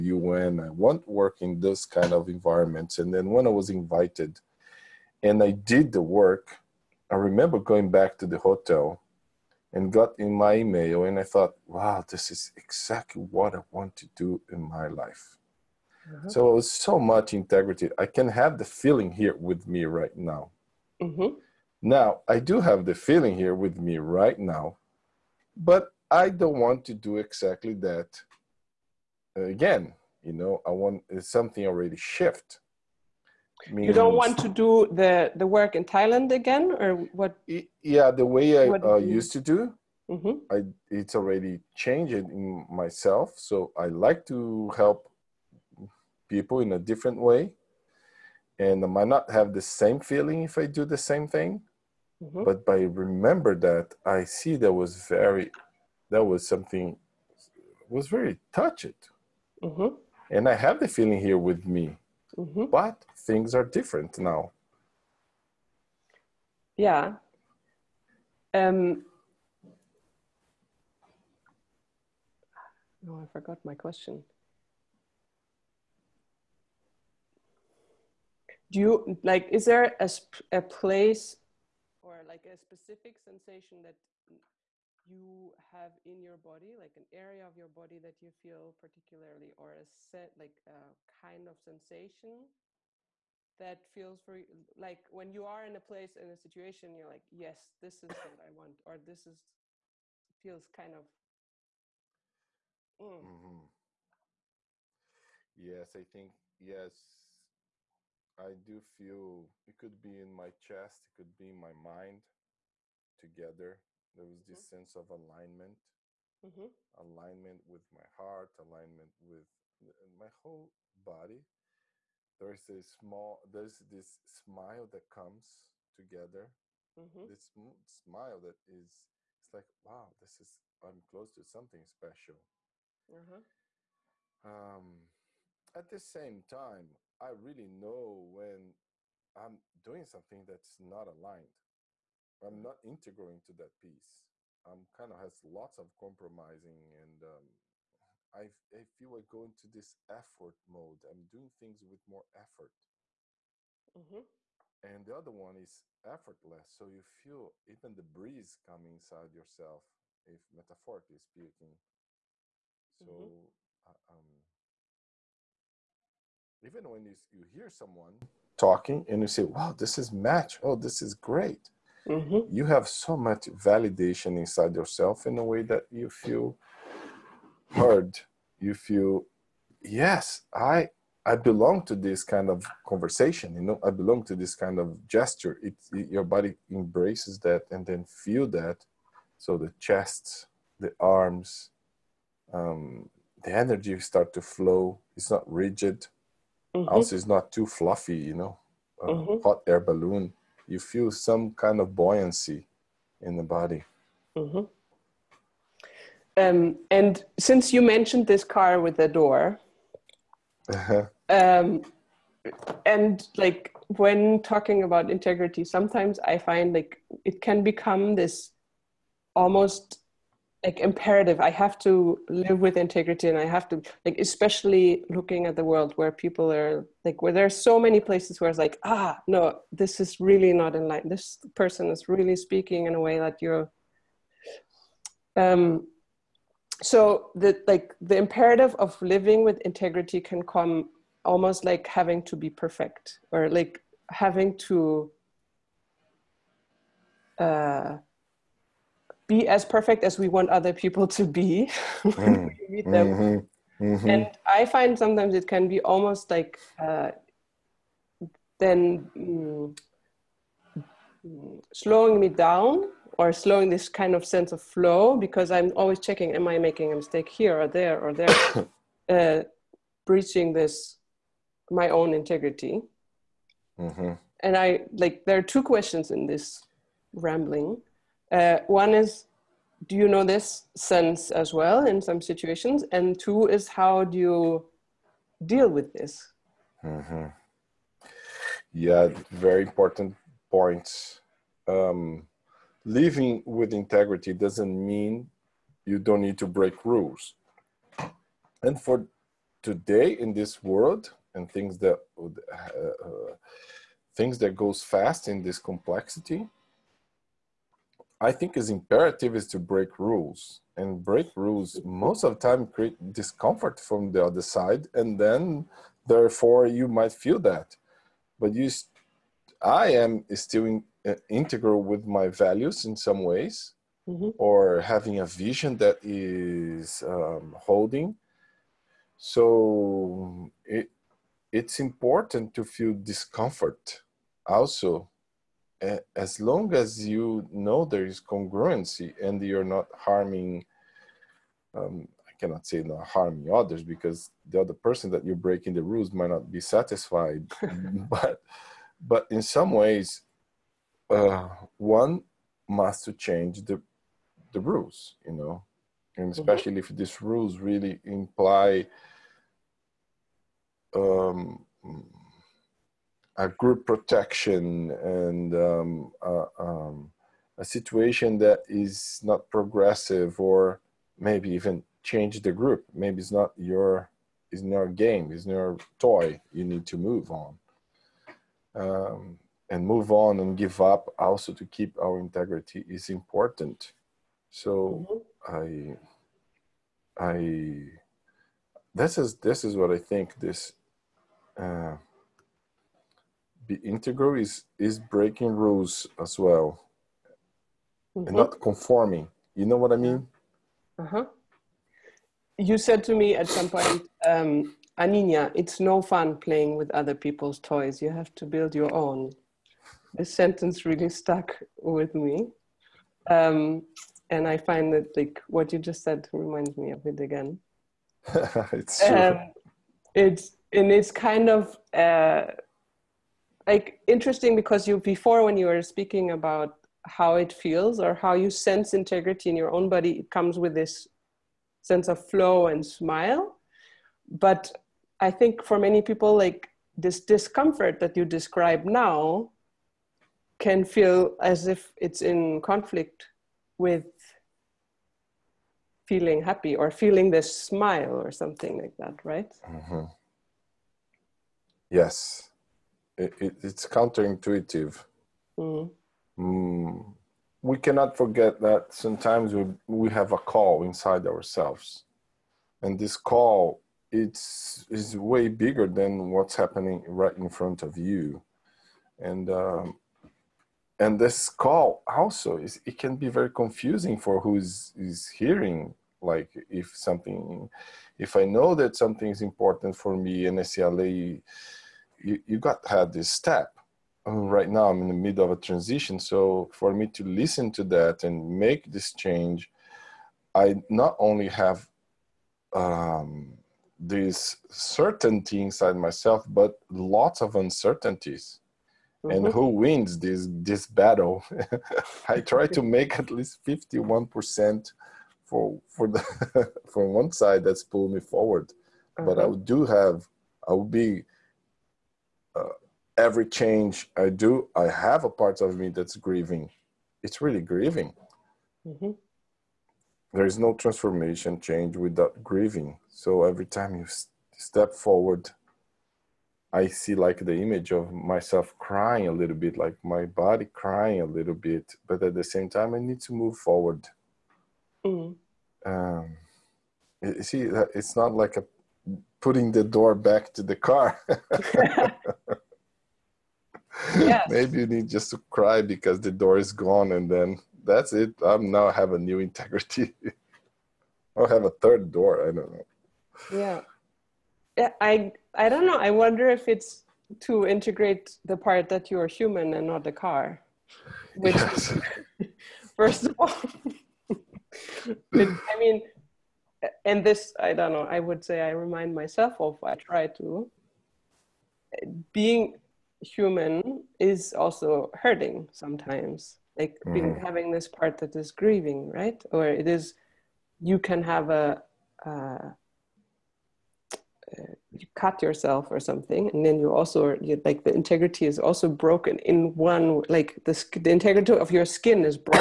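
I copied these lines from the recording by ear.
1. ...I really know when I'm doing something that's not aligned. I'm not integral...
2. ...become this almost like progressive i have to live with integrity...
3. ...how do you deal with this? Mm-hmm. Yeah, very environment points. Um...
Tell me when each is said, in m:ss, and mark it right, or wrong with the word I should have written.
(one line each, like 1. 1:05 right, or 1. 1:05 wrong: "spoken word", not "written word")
1. 2:17 right
2. 3:37 wrong: "imperative", not "progressive"
3. 4:43 wrong: "important", not "environment".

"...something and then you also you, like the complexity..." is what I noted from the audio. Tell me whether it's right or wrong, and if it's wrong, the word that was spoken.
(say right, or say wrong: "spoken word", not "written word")
wrong: "integrity", not "complexity".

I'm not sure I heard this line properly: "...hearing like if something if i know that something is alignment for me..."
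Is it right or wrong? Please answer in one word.
wrong.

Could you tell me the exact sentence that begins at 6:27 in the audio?
i i this is this is what i think this uh, be integral is is breaking rules as well mm-hmm.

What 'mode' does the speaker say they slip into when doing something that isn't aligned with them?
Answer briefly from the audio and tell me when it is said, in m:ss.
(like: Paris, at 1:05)
effort mode, at 2:30.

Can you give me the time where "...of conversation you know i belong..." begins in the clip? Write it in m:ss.
3:02.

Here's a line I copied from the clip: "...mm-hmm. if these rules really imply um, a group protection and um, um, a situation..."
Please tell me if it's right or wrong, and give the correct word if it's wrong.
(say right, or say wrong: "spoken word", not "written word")
right.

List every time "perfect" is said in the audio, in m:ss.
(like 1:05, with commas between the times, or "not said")
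4:02, 4:09.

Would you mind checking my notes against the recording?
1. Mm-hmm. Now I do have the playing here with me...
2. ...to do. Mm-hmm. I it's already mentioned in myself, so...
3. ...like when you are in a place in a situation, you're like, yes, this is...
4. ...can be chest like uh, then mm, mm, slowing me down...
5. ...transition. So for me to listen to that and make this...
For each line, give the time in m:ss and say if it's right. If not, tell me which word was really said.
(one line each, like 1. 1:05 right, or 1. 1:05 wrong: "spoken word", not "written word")
1. 0:21 wrong: "feeling", not "playing"
2. 0:39 wrong: "changed", not "mentioned"
3. 1:34 right
4. 4:15 wrong: "almost", not "chest"
5. 8:05 right.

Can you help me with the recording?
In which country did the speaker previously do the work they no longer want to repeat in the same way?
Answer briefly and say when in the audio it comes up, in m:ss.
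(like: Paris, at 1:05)
Thailand, at 0:35.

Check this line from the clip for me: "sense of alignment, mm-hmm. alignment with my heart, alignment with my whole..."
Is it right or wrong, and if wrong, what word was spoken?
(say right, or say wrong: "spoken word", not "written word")
right.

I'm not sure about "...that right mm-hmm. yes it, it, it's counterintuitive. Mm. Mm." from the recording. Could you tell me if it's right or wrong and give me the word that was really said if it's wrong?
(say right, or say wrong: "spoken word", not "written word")
right.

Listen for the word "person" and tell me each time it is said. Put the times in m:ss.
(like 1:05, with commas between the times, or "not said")
3:51, 5:44.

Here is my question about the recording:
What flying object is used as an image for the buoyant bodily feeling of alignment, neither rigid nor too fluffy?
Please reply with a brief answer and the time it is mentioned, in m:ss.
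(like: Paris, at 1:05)
hot air balloon, at 3:19.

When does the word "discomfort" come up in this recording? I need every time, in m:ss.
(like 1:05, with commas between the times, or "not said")
5:13, 5:32, 7:17.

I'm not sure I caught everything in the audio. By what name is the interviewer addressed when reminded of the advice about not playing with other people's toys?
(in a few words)
Aninia.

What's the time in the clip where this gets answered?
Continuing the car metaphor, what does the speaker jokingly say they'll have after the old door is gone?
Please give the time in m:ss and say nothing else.
9:11.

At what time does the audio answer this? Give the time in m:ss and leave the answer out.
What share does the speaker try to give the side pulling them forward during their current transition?
8:23.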